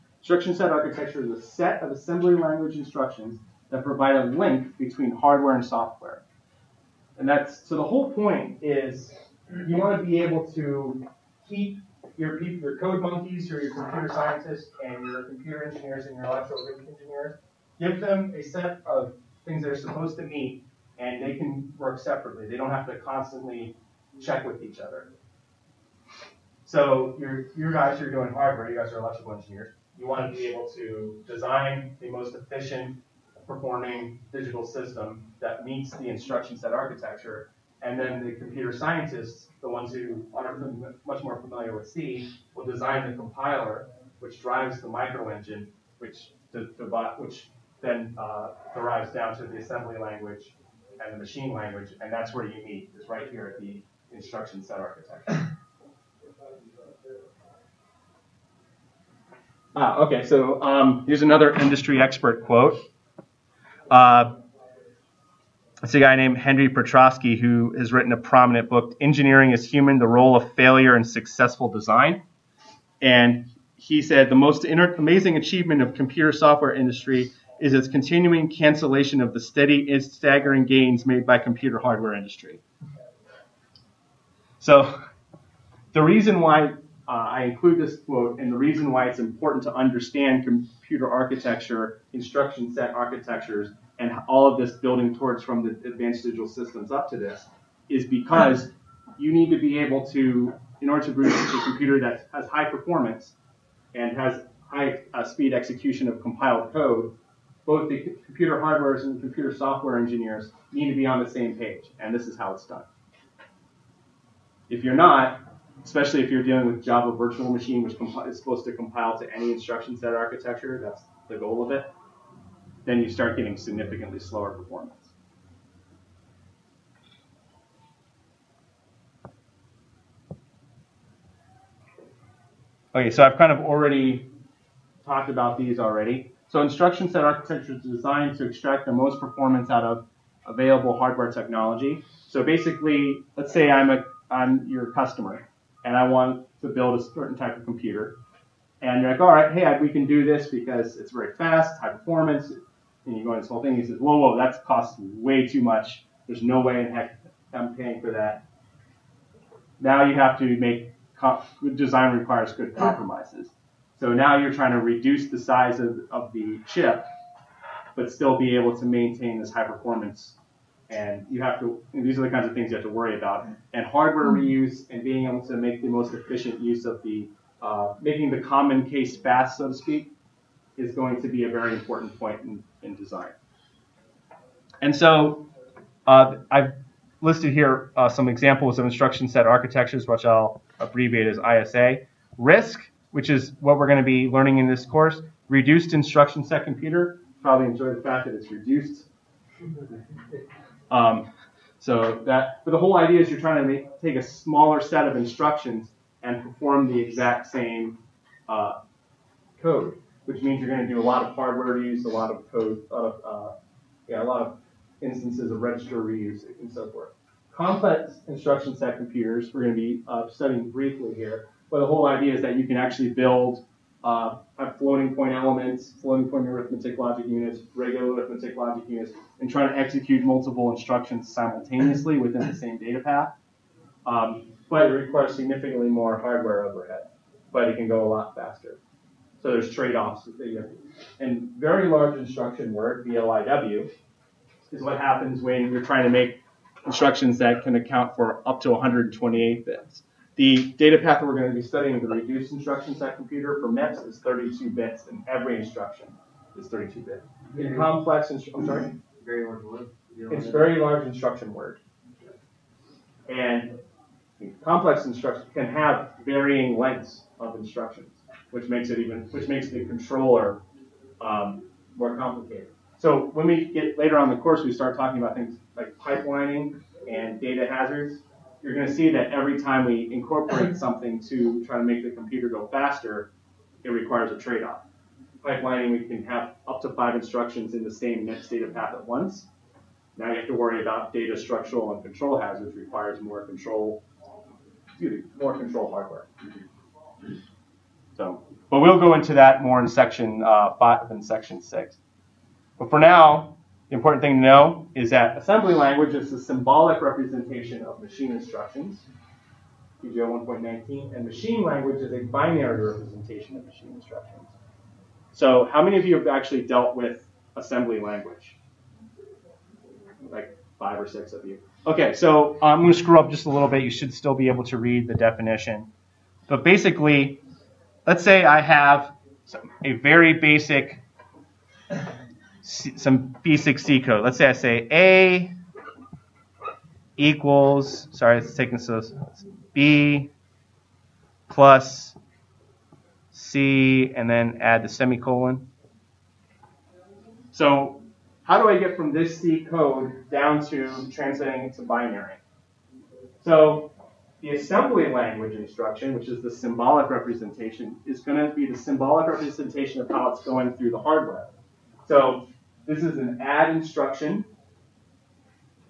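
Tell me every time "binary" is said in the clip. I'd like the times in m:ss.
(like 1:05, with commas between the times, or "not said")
5:12, 5:51.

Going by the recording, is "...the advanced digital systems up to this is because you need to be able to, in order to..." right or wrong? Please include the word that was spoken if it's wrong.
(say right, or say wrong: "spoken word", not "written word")
right.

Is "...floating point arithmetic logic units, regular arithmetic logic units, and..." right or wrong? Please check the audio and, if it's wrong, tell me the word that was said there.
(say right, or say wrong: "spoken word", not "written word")
right.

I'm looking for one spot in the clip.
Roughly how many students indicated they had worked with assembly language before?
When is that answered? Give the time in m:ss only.
5:20.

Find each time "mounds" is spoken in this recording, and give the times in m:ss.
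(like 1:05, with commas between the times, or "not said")
not said.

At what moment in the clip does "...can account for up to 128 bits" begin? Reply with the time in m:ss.
4:07.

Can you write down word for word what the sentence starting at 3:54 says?
Um, but it requires significantly more hardware overhead, but it can go a lot faster.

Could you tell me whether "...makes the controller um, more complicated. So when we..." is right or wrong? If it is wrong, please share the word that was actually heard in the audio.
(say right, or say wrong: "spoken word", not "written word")
right.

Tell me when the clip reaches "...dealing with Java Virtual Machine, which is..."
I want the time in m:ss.
1:56.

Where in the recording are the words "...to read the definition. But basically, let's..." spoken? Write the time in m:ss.
5:24.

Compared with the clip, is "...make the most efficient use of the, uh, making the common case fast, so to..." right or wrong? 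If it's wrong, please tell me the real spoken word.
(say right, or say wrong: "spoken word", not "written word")
right.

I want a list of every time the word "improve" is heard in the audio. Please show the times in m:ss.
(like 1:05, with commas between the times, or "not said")
not said.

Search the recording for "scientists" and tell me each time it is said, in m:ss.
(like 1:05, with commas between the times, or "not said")
0:14, 0:38.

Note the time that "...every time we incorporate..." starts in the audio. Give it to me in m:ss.
4:39.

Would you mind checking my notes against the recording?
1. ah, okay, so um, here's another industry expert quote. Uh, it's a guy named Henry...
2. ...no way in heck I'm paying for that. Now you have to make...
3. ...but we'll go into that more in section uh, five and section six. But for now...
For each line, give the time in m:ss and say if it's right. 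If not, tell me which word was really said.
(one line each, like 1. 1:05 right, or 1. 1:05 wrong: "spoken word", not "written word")
1. 0:59 right
2. 2:36 right
3. 4:58 right.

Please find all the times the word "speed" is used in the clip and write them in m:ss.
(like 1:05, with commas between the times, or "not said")
1:45.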